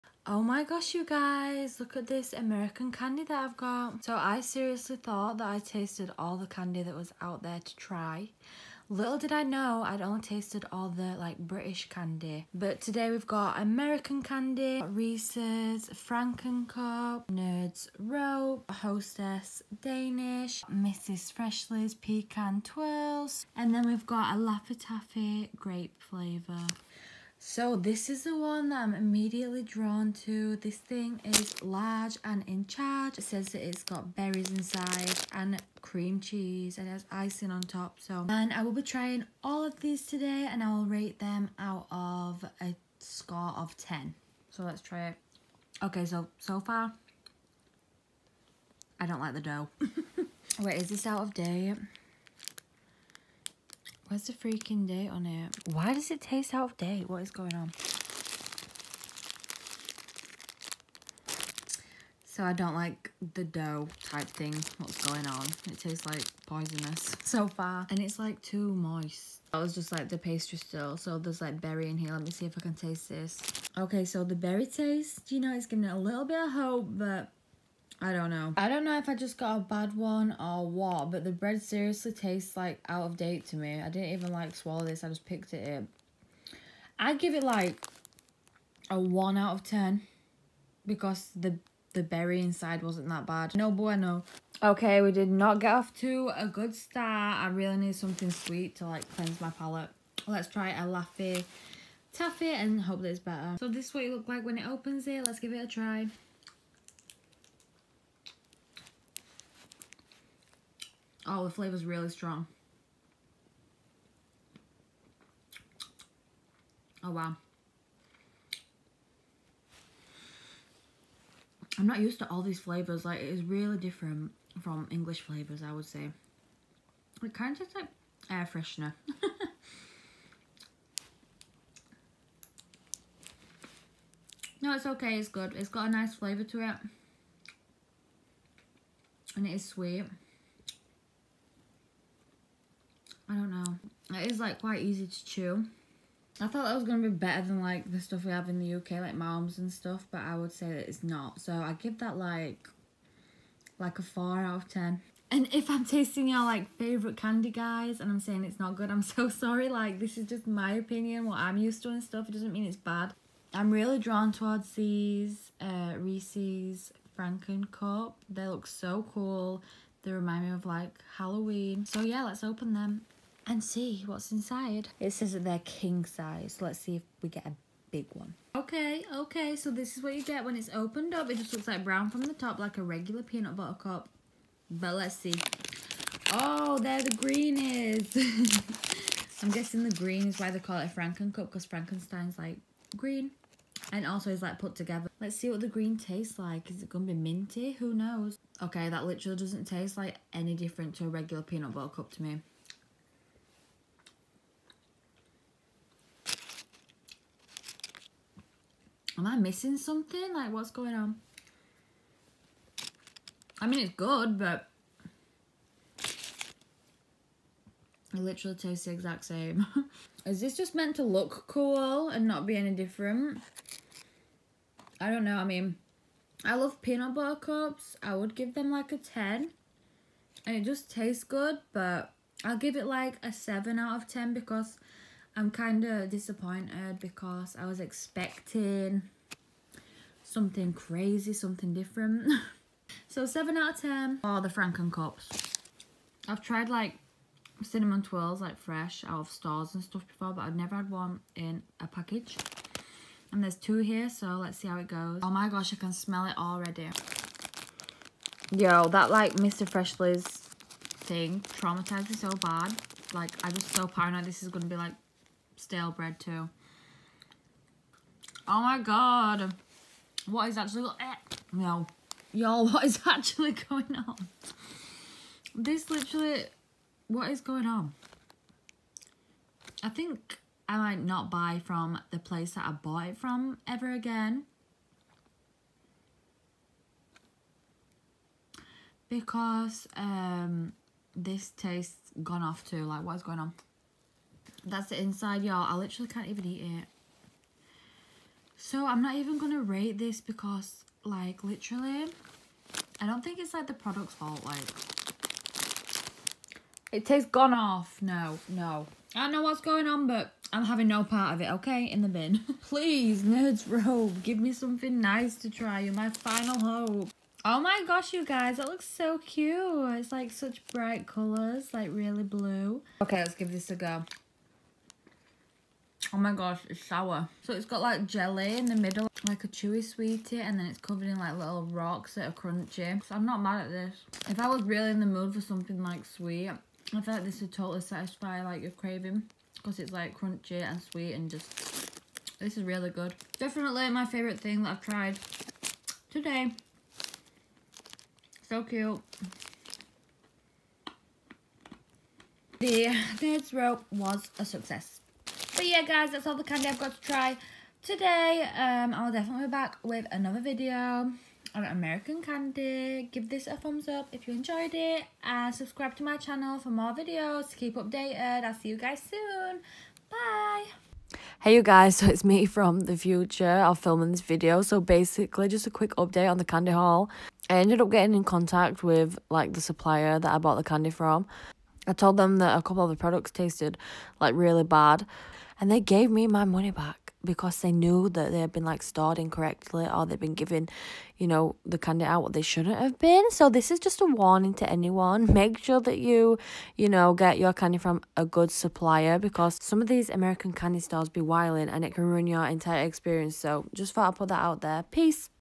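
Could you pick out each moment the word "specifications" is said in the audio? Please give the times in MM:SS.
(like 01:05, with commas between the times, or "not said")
not said.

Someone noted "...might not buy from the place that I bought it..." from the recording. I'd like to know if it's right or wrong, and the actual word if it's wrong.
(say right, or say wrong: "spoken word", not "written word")
right.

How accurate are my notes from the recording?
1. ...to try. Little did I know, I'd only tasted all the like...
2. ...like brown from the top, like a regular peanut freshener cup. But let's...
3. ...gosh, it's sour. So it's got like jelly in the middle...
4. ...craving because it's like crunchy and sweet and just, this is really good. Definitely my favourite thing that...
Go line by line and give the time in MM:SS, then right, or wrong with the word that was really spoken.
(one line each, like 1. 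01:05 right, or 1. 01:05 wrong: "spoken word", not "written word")
1. 00:07 right
2. 03:01 wrong: "butter", not "freshener"
3. 05:26 right
4. 05:38 right.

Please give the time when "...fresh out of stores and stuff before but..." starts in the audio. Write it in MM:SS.
04:08.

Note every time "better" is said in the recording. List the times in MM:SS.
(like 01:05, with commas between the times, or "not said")
01:43, 02:27.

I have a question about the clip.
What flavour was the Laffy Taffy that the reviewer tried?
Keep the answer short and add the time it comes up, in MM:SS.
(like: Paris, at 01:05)
grape, at 00:25.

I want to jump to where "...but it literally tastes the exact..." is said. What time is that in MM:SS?
03:34.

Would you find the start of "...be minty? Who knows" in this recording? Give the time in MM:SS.
03:17.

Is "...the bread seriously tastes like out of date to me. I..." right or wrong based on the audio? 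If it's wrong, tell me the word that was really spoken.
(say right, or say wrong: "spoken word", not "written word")
right.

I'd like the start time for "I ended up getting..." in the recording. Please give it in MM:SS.
06:17.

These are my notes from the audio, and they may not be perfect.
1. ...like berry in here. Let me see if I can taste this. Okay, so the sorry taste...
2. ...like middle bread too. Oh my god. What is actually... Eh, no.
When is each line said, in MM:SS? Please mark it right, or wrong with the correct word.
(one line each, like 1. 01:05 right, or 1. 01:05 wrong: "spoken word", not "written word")
1. 01:11 wrong: "berry", not "sorry"
2. 04:24 wrong: "stale", not "middle".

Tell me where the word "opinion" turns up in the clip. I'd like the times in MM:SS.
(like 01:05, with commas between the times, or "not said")
02:40.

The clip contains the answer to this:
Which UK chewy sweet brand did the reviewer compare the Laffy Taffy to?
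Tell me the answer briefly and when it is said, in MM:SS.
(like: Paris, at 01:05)
Maoams, at 02:29.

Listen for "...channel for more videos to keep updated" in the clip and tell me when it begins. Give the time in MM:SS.
06:06.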